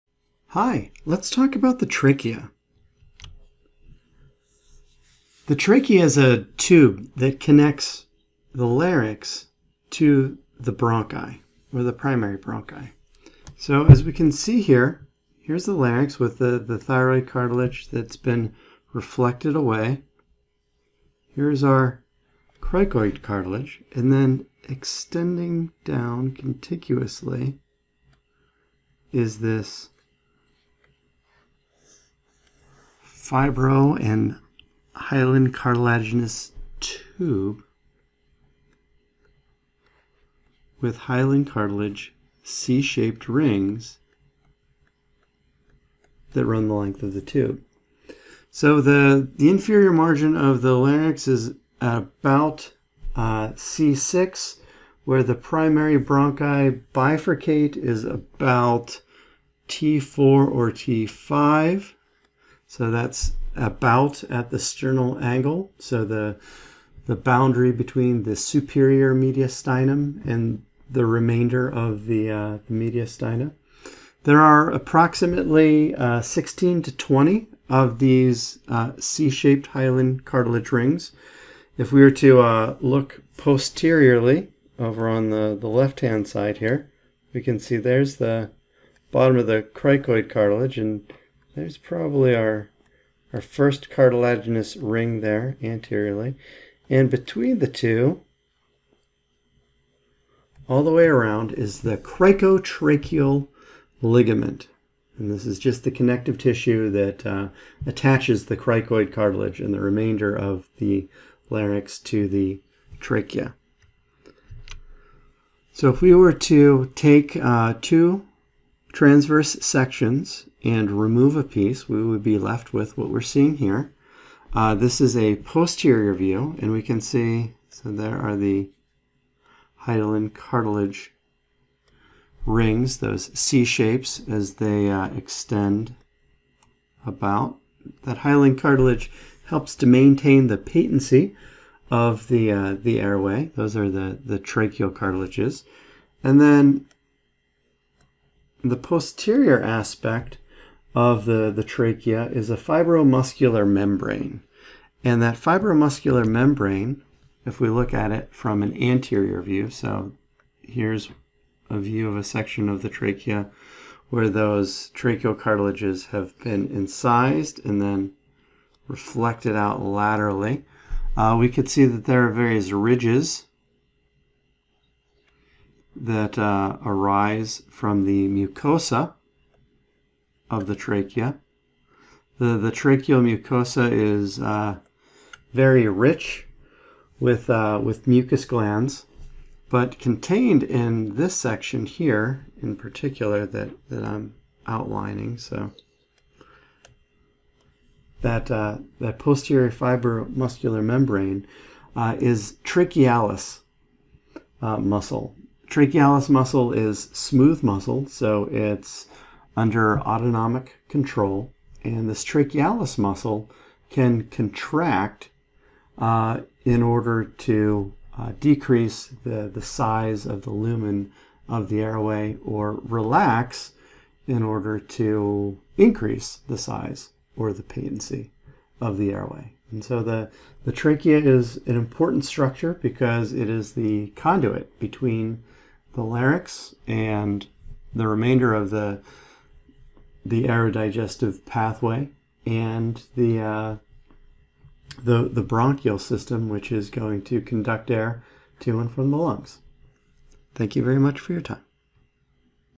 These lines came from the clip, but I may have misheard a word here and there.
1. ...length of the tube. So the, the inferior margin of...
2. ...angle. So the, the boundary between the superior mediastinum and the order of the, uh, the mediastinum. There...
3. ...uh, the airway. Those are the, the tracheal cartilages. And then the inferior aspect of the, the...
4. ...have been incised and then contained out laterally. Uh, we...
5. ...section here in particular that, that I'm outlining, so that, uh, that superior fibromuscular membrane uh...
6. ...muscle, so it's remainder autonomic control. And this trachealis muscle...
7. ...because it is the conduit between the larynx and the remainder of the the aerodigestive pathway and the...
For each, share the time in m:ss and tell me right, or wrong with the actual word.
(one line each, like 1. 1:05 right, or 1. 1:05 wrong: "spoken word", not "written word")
1. 0:46 right
2. 1:05 wrong: "remainder", not "order"
3. 2:22 wrong: "posterior", not "inferior"
4. 2:46 wrong: "reflected", not "contained"
5. 3:11 wrong: "posterior", not "superior"
6. 3:27 wrong: "under", not "remainder"
7. 3:52 right.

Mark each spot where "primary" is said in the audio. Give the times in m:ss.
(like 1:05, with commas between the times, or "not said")
0:11, 0:55.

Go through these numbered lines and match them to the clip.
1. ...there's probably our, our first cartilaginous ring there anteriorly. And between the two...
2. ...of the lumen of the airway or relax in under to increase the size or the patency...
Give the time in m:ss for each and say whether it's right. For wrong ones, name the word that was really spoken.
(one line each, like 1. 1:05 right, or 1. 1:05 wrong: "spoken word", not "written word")
1. 1:31 right
2. 3:40 wrong: "order", not "under".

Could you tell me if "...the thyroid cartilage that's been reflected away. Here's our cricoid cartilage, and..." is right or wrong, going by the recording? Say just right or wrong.
right.